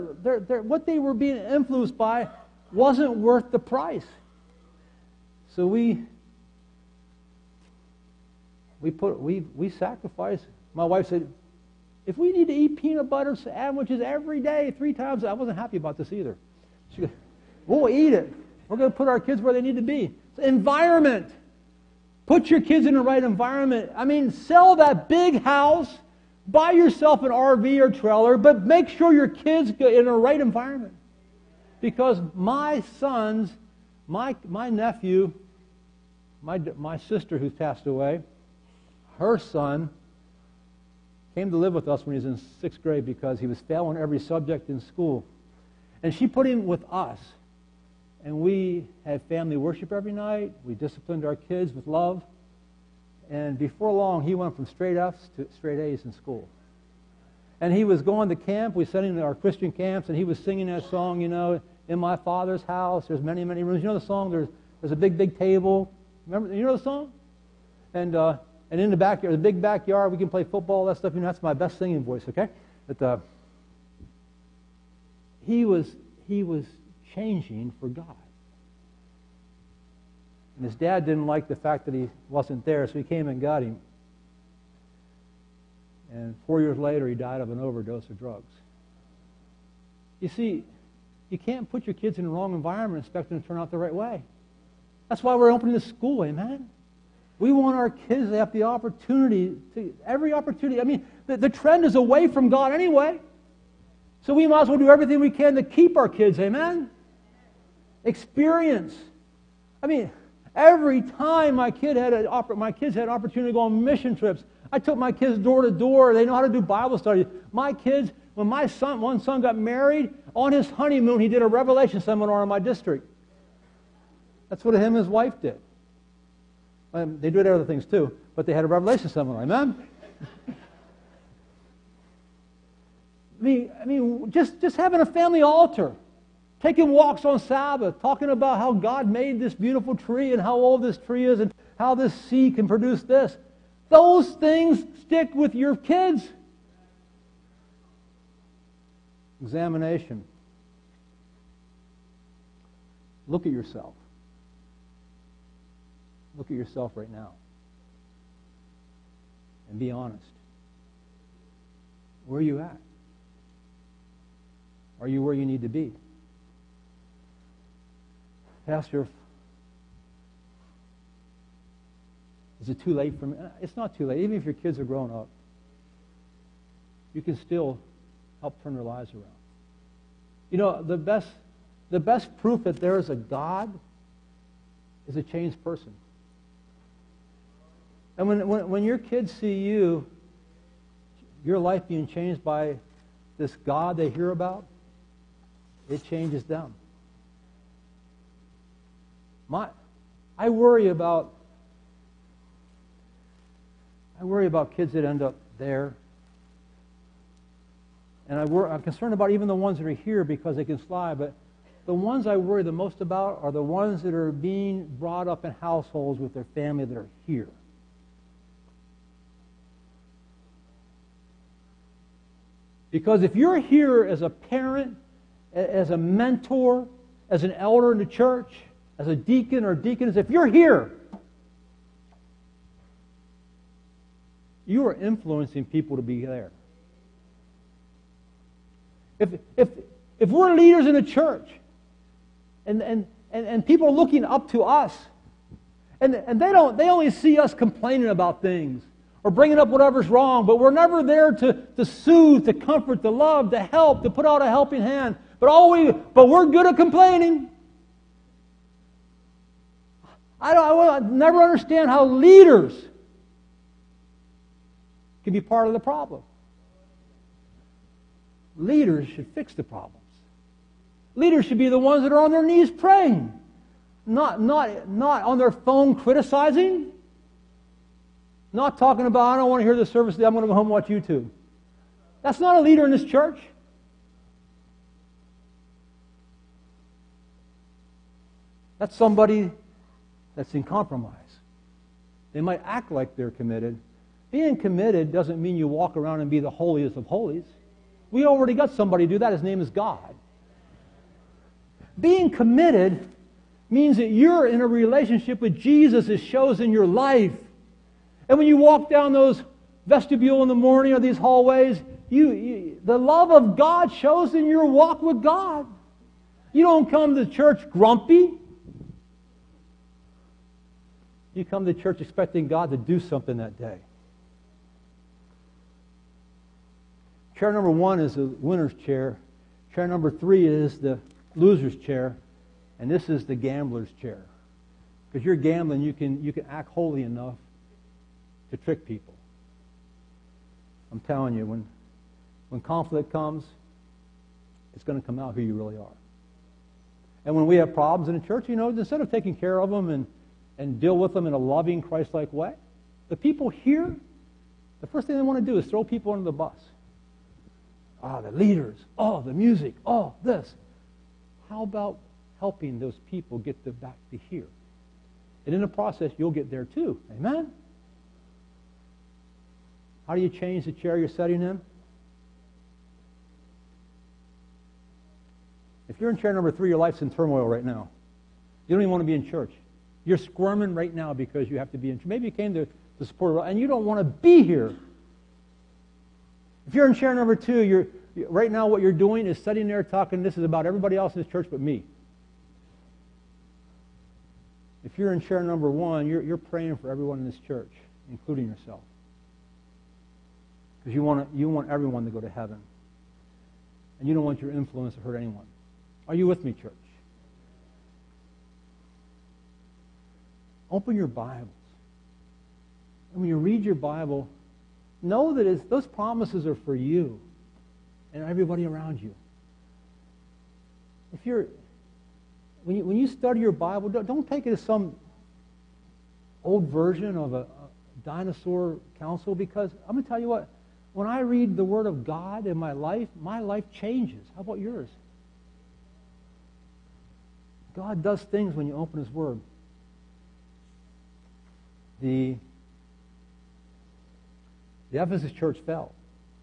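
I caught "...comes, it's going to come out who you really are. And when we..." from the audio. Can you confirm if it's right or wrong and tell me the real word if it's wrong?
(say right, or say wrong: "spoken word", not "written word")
right.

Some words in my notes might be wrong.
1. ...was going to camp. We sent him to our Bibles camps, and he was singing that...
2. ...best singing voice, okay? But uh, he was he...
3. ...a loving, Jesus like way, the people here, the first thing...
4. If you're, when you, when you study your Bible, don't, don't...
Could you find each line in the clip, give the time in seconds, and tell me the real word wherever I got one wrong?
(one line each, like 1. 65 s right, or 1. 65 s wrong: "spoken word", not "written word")
1. 57 s wrong: "Christian", not "Bibles"
2. 71 s right
3. 351 s wrong: "Christ", not "Jesus"
4. 421 s right.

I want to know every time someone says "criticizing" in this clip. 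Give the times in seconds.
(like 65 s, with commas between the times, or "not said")
275 s.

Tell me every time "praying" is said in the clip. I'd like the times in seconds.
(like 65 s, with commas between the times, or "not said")
272 s, 396 s.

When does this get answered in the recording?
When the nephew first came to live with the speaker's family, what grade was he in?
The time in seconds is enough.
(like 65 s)
42 s.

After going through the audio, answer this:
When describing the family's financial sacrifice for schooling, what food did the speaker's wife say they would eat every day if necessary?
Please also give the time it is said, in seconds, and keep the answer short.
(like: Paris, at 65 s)
peanut butter sandwiches, at 12 s.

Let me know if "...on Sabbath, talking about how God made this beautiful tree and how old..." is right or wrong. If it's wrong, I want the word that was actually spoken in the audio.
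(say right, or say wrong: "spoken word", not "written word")
right.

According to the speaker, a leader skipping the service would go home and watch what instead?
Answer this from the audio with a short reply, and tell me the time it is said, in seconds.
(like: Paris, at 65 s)
YouTube, at 280 s.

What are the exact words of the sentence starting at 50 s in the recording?
We disciplined our kids with love.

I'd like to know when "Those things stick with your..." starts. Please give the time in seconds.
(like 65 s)
143 s.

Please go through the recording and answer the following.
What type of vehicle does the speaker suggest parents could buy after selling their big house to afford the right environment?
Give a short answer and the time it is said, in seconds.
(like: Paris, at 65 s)
RV or trailer, at 27 s.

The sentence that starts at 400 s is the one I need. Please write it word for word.
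Because you want, you want everyone to go to heaven.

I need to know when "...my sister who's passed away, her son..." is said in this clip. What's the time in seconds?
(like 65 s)
36 s.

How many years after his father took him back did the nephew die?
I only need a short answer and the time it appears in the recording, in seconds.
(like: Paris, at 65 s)
4, at 86 s.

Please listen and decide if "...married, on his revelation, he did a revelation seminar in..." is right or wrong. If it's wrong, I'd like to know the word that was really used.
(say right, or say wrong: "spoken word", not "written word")
wrong: "honeymoon", not "revelation".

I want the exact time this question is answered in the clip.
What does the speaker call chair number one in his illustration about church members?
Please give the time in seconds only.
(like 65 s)
328 s.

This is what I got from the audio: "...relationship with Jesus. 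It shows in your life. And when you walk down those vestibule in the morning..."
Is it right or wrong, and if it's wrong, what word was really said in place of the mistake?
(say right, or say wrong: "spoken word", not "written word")
right.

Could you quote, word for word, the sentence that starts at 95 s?
That's why we're opening the school, amen?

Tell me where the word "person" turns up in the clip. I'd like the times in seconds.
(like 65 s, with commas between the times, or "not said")
185 s.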